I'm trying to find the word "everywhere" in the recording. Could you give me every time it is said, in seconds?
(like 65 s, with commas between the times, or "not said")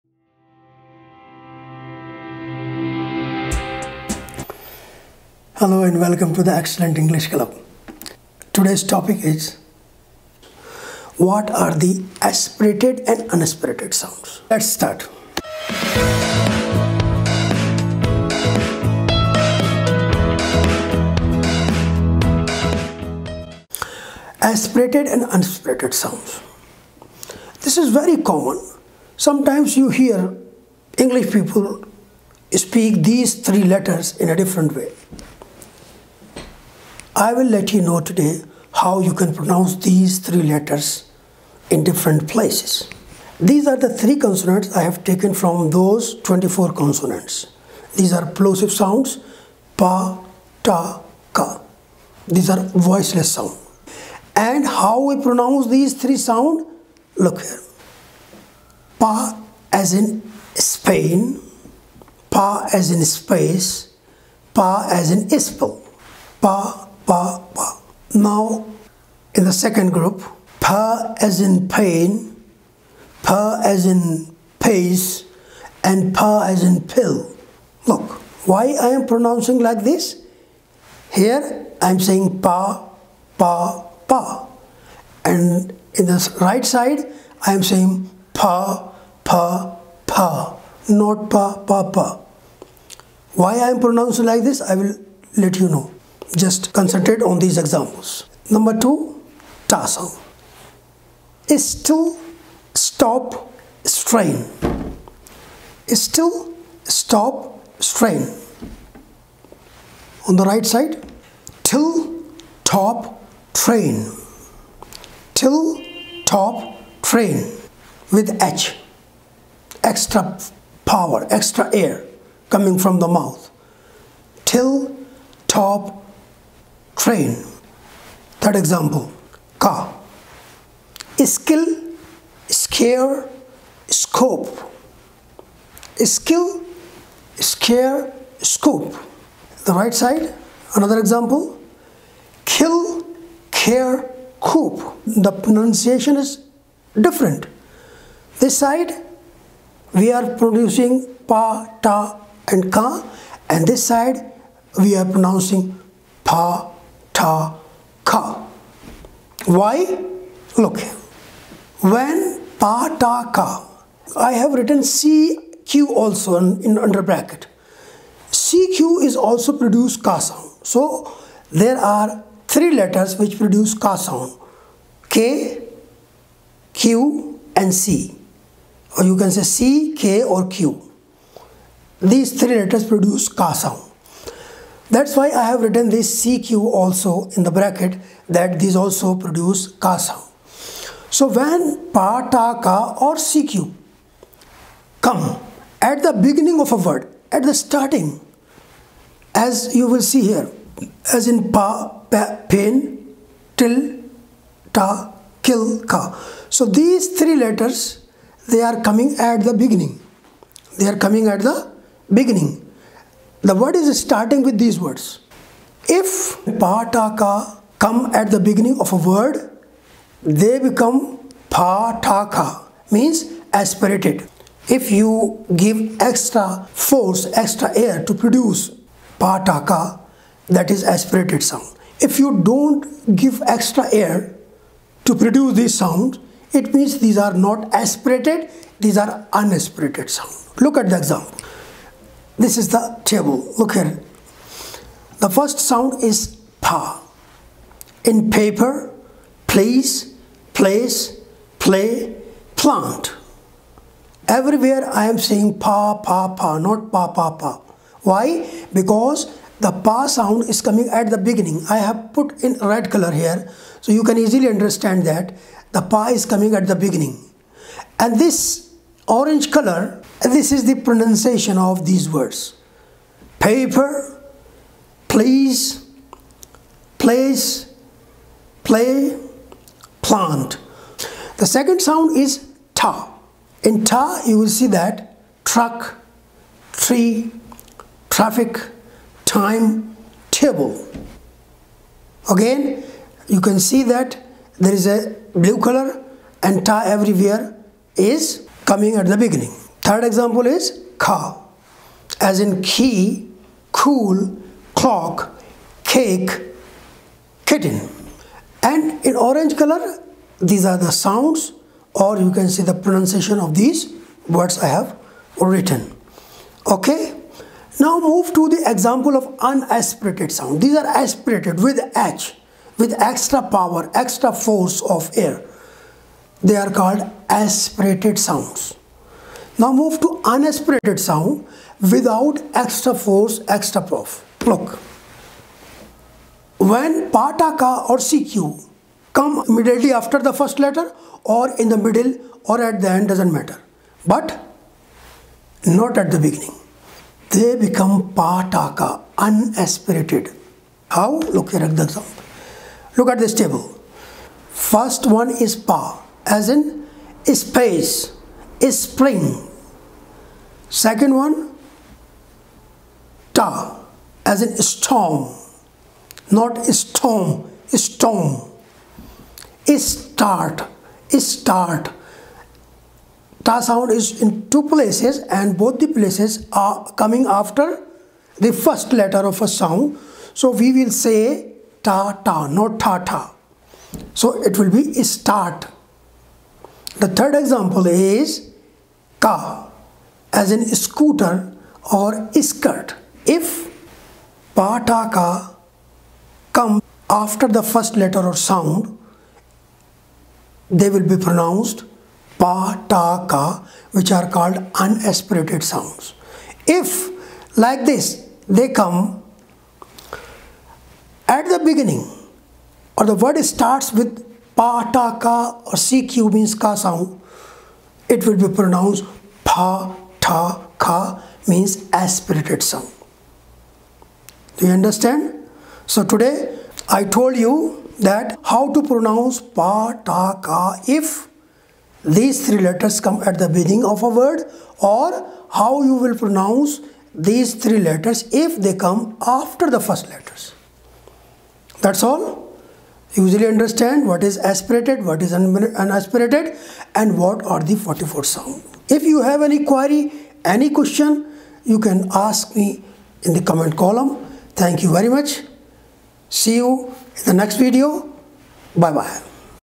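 254 s, 296 s.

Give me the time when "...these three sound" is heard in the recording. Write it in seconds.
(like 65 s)
55 s.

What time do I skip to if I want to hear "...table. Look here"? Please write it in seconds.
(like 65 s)
243 s.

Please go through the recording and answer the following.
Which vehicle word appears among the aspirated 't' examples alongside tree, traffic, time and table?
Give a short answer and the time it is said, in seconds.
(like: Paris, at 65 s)
Truck, at 285 s.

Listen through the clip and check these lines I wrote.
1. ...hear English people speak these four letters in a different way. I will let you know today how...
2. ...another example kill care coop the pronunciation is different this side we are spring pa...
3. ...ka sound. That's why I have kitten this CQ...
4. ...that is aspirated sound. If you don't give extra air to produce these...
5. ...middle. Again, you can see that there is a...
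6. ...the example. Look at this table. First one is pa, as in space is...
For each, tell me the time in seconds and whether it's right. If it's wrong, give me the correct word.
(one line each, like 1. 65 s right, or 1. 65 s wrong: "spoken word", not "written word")
1. 29 s wrong: "three", not "four"
2. 140 s wrong: "producing", not "spring"
3. 183 s wrong: "written", not "kitten"
4. 230 s right
5. 290 s wrong: "table", not "middle"
6. 351 s right.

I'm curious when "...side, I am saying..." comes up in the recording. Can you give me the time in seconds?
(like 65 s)
86 s.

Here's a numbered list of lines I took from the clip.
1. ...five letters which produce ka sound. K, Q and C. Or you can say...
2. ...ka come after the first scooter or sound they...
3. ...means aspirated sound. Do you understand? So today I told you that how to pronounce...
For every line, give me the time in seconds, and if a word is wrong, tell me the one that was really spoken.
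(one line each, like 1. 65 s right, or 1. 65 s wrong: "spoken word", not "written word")
1. 172 s wrong: "three", not "five"
2. 395 s wrong: "letter", not "scooter"
3. 421 s right.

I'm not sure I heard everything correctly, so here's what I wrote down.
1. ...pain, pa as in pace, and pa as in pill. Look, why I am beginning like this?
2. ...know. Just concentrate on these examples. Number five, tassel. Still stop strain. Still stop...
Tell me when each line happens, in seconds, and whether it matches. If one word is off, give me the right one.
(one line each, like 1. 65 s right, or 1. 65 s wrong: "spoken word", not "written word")
1. 71 s wrong: "pronouncing", not "beginning"
2. 95 s wrong: "two", not "five".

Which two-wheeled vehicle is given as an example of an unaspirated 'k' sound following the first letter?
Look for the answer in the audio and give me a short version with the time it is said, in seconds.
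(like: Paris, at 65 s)
Scooter, at 390 s.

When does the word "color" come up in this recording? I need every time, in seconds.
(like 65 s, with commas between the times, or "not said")
262 s, 269 s, 295 s, 309 s.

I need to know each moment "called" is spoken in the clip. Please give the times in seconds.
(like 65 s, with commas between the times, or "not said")
326 s, 404 s.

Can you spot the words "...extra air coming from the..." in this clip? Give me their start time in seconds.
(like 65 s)
121 s.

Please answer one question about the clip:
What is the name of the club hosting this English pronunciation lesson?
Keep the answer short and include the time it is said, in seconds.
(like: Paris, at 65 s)
Excellent English Club, at 6 s.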